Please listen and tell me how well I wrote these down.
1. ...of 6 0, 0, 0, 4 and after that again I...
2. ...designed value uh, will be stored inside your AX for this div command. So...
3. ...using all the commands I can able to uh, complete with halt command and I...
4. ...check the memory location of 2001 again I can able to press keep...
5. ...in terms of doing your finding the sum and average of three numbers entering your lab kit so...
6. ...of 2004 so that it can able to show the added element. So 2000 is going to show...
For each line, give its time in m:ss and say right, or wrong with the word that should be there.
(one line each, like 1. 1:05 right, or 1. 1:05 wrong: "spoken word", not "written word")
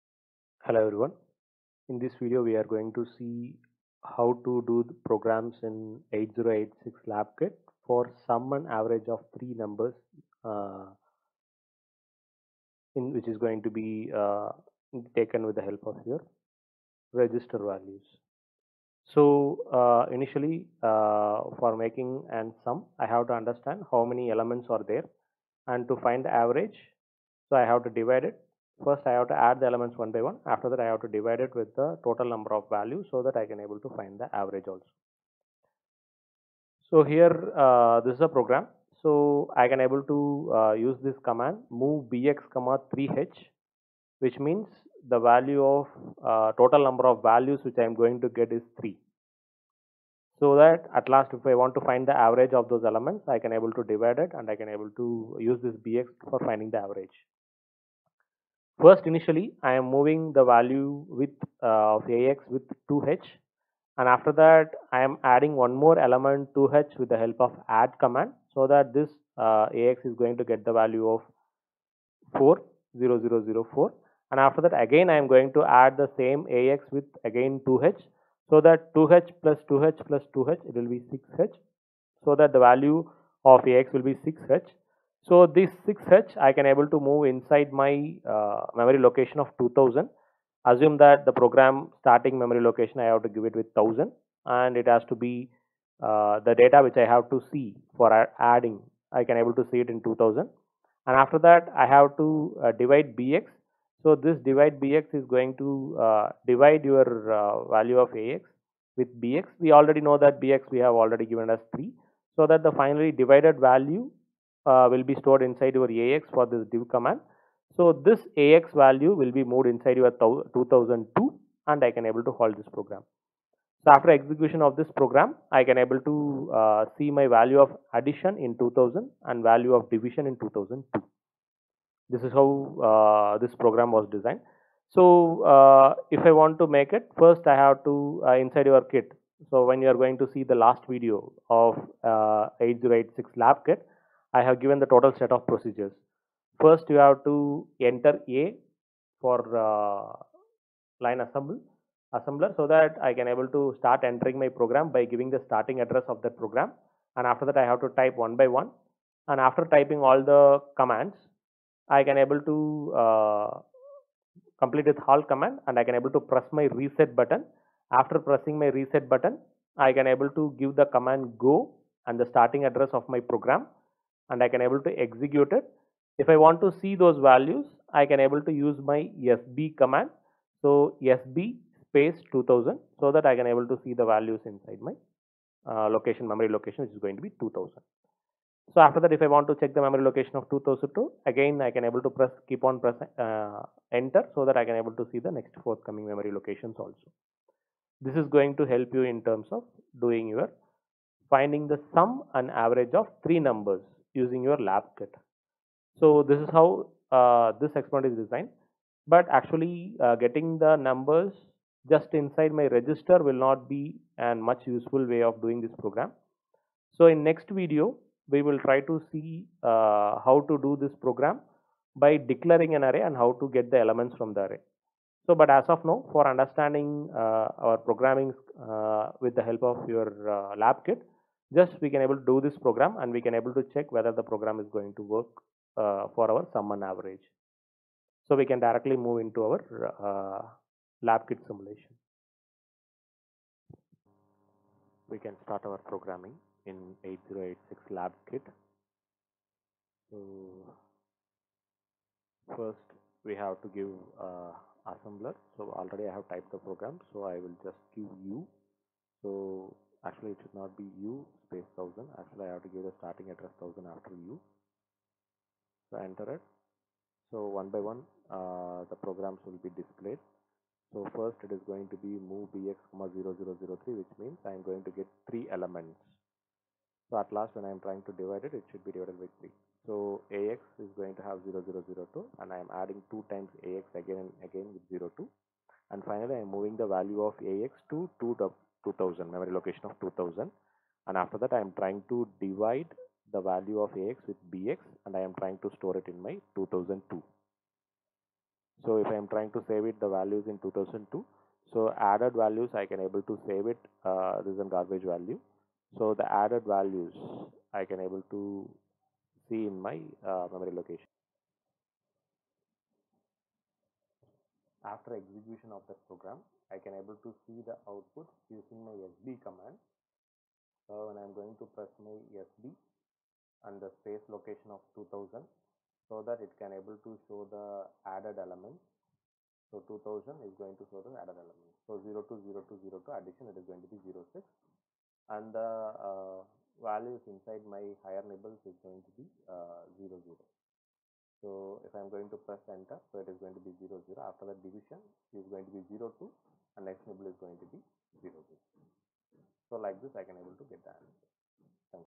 1. 1:11 wrong: "4", not "6"
2. 1:53 wrong: "divided", not "designed"
3. 2:39 wrong: "typing", not "using"
4. 3:09 wrong: "2002", not "2001"
5. 3:19 wrong: "using", not "entering"
6. 5:24 wrong: "2000", not "2004".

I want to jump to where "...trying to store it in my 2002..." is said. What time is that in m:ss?
4:55.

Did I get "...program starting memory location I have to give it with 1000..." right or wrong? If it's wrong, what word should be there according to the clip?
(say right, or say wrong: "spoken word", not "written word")
right.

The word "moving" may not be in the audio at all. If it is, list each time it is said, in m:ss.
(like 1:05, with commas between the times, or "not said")
0:59, 4:46.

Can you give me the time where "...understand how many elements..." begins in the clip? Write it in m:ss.
0:23.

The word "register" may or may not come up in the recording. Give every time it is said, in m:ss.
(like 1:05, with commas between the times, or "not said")
0:17, 3:32.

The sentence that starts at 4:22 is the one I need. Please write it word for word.
Actually, I have to give the starting address 1000 after u.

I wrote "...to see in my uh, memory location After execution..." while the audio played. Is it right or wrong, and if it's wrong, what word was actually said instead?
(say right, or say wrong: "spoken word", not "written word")
right.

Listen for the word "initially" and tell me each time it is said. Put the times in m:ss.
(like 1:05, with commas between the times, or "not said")
0:20, 0:59.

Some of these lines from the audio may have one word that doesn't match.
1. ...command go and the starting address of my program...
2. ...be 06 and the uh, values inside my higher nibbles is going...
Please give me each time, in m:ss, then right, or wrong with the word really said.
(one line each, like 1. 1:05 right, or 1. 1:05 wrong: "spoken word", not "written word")
1. 2:50 right
2. 5:33 right.